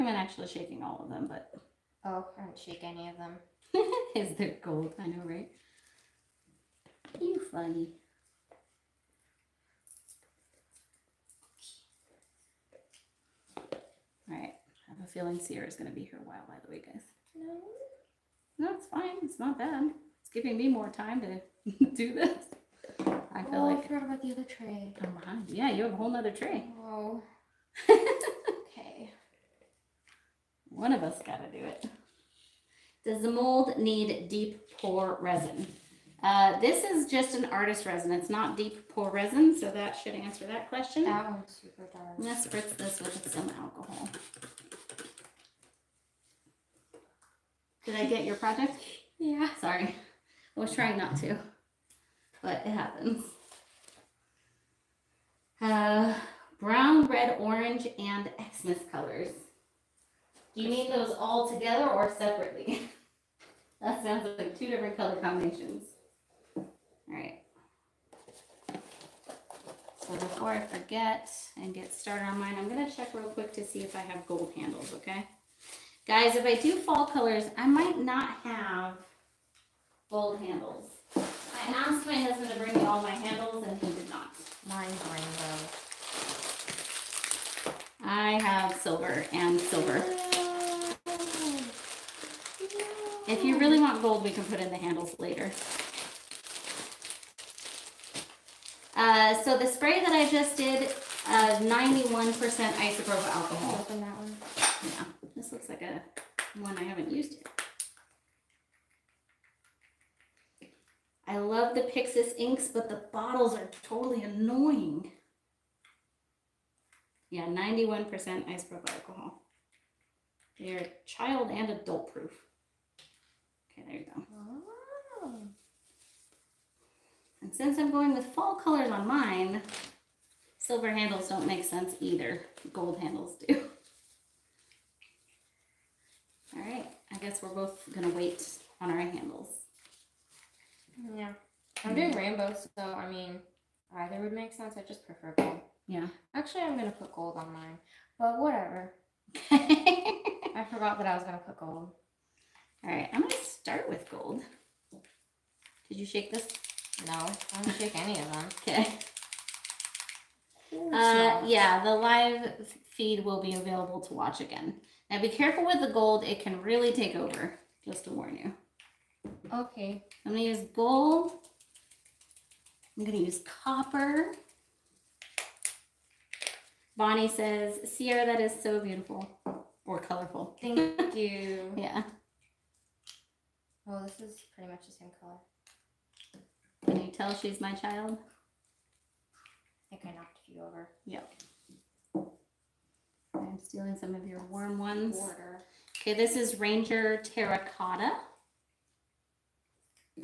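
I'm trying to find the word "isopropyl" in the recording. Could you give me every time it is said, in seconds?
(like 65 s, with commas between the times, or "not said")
102 s, 118 s.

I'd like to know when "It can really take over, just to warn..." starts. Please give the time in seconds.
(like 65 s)
166 s.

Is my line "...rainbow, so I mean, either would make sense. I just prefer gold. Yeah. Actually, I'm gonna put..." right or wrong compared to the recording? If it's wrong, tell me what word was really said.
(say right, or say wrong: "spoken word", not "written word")
right.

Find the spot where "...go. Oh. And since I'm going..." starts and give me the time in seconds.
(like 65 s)
124 s.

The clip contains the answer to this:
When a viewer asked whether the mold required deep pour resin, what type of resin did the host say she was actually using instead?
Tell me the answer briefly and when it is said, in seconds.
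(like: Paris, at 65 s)
artist resin, at 37 s.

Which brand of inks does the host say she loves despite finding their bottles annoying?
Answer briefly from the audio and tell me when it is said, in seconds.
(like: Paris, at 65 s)
Pixiss, at 111 s.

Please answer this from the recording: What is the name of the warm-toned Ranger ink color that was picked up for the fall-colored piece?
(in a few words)
Terracotta.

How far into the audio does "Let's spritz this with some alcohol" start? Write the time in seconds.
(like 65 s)
42 s.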